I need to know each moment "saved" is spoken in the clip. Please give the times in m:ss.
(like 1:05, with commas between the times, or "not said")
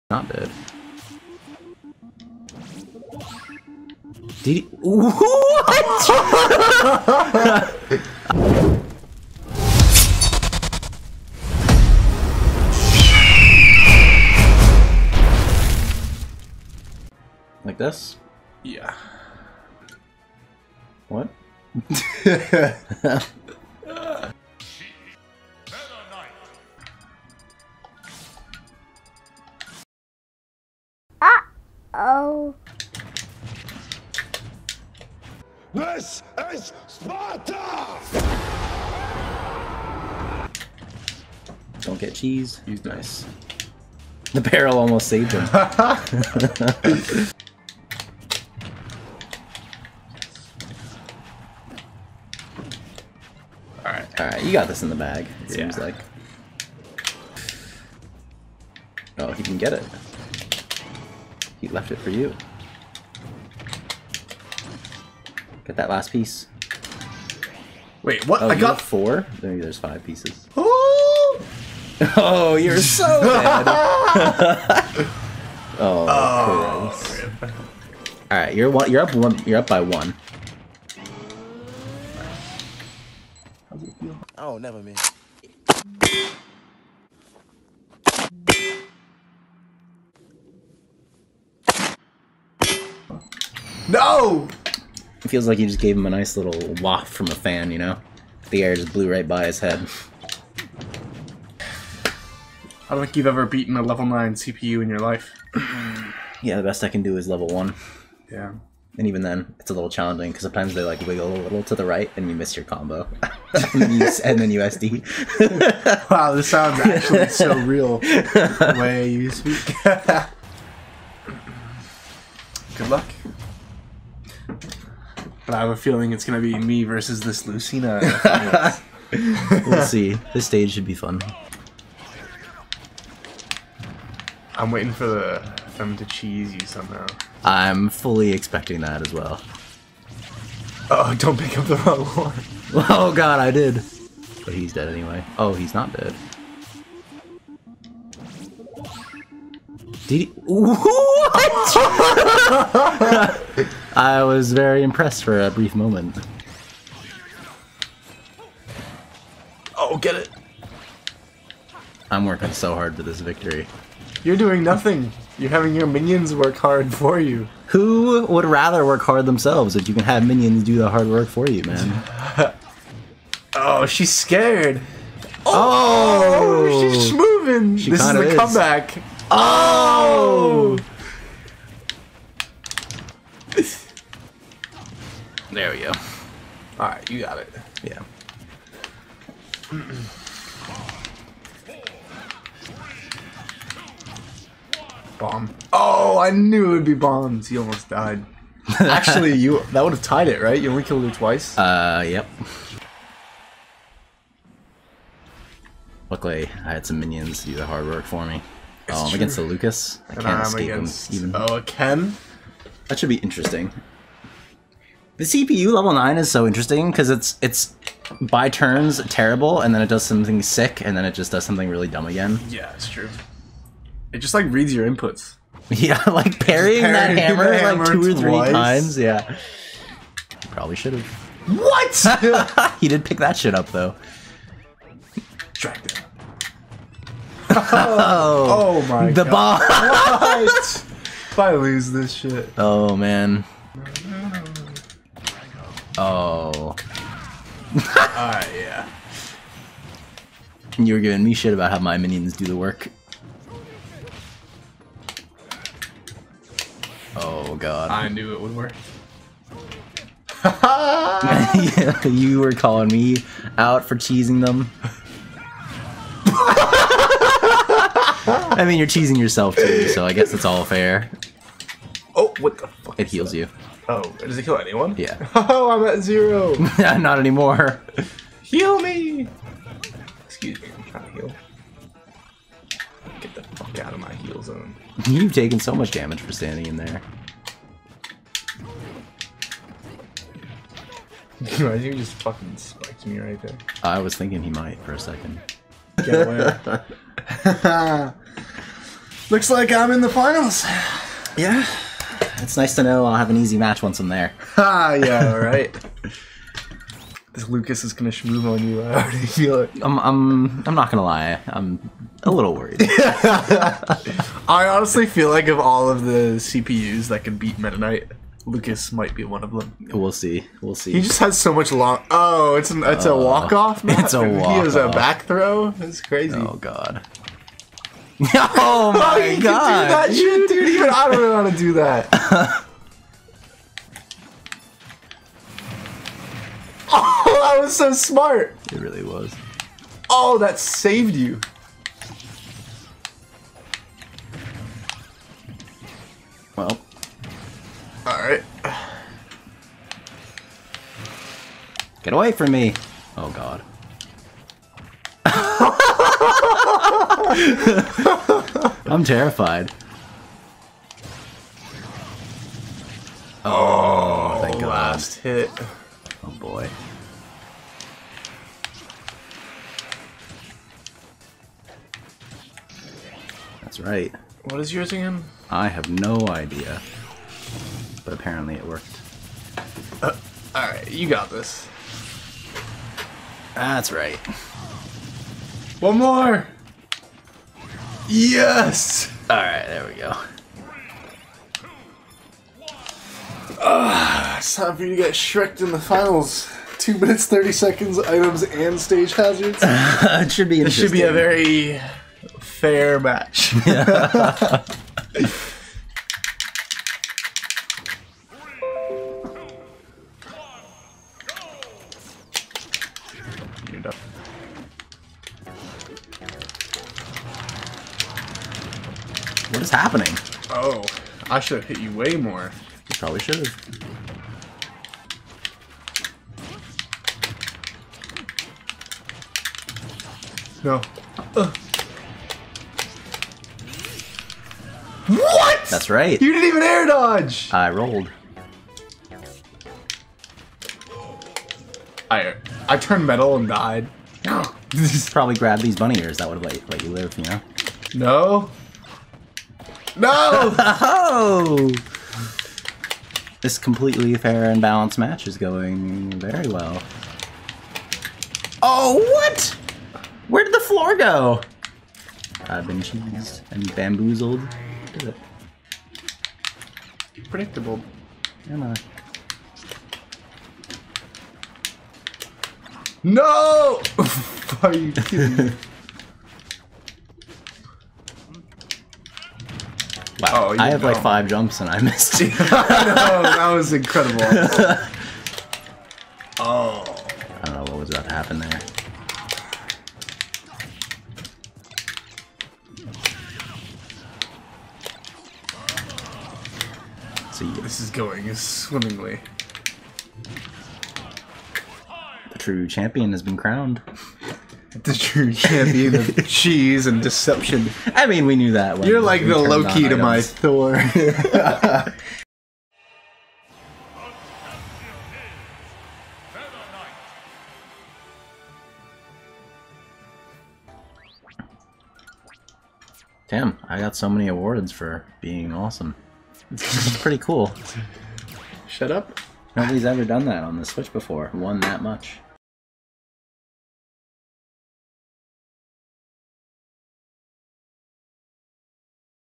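0:45, 5:40.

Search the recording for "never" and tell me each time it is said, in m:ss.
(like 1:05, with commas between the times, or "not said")
1:24.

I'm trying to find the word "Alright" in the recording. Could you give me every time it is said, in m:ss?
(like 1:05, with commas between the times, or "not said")
0:45, 0:54, 4:08, 6:20, 6:29.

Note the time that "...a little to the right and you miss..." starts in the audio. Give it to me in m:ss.
1:51.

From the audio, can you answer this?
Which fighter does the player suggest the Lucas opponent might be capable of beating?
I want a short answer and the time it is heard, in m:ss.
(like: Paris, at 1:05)
Meta Knight, at 5:17.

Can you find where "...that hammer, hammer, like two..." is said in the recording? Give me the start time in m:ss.
3:47.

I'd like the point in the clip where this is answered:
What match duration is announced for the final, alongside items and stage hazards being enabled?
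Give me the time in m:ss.
6:36.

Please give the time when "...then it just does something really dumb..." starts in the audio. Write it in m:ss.
3:40.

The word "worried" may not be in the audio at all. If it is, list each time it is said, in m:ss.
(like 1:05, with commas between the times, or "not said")
5:12.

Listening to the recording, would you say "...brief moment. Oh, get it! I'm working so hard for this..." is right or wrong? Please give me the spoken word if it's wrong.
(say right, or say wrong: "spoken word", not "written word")
right.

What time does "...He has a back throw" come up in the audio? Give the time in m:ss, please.
5:24.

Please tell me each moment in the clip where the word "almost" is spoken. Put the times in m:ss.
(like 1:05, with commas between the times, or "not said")
0:44, 3:17.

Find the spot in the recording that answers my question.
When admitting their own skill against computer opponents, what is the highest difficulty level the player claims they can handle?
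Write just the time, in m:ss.
1:47.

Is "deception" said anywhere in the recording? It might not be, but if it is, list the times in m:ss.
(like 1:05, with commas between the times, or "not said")
8:27.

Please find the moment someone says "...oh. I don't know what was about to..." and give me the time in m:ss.
8:06.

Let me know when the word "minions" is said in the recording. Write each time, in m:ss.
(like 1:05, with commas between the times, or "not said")
2:45, 2:50, 3:26, 4:11.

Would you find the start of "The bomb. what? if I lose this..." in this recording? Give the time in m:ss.
3:59.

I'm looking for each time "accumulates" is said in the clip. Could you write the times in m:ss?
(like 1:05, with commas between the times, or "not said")
not said.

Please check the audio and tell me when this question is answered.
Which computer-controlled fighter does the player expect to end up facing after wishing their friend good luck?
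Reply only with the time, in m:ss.
2:07.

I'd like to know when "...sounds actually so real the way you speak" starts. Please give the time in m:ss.
1:56.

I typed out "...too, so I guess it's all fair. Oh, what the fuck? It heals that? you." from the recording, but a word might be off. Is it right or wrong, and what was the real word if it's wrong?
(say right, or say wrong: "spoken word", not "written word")
right.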